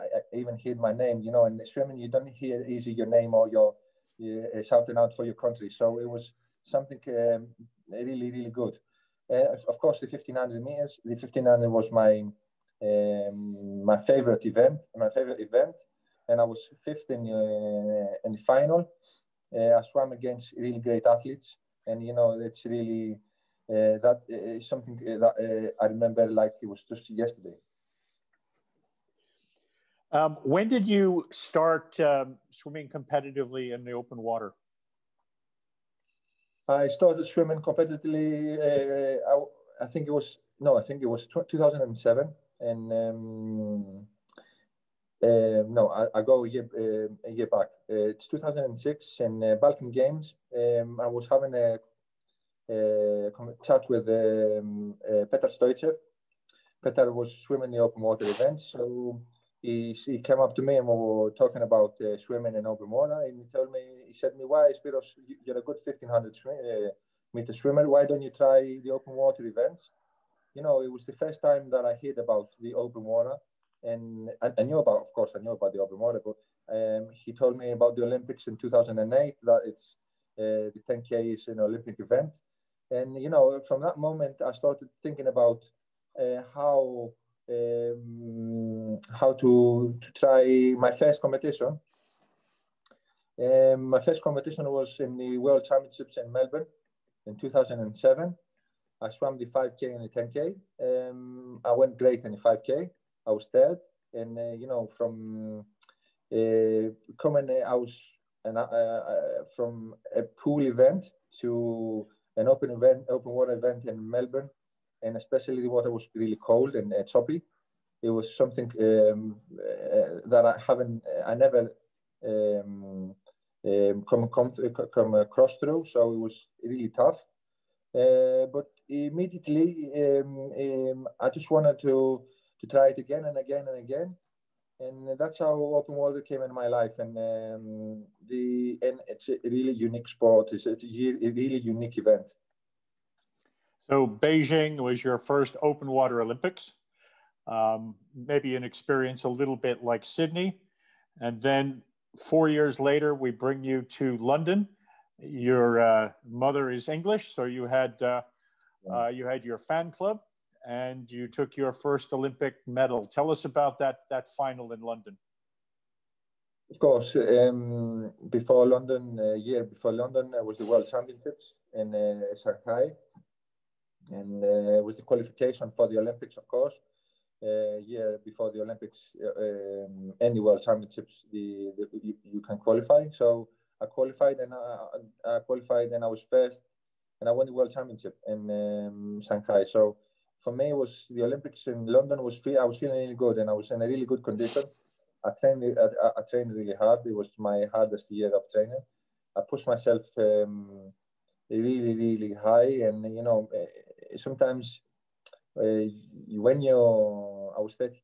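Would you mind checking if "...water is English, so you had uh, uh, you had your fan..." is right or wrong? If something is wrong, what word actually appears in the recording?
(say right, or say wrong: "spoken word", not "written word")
wrong: "mother", not "water".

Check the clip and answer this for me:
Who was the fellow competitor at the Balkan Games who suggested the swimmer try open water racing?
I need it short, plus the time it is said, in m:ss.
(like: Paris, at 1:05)
Petar Stoichev, at 0:55.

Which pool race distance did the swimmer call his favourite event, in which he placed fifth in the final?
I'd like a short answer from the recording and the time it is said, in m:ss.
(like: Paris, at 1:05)
1500 meters, at 0:09.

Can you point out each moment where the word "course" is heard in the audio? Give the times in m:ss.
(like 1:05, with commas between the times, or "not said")
0:09, 1:15, 2:46, 2:56.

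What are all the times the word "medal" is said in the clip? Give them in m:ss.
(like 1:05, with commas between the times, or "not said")
2:42.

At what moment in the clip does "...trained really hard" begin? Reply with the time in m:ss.
3:16.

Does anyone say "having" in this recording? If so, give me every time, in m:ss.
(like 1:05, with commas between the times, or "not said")
0:51.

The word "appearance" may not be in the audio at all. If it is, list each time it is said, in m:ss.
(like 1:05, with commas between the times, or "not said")
not said.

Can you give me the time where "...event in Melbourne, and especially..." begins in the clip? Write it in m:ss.
1:53.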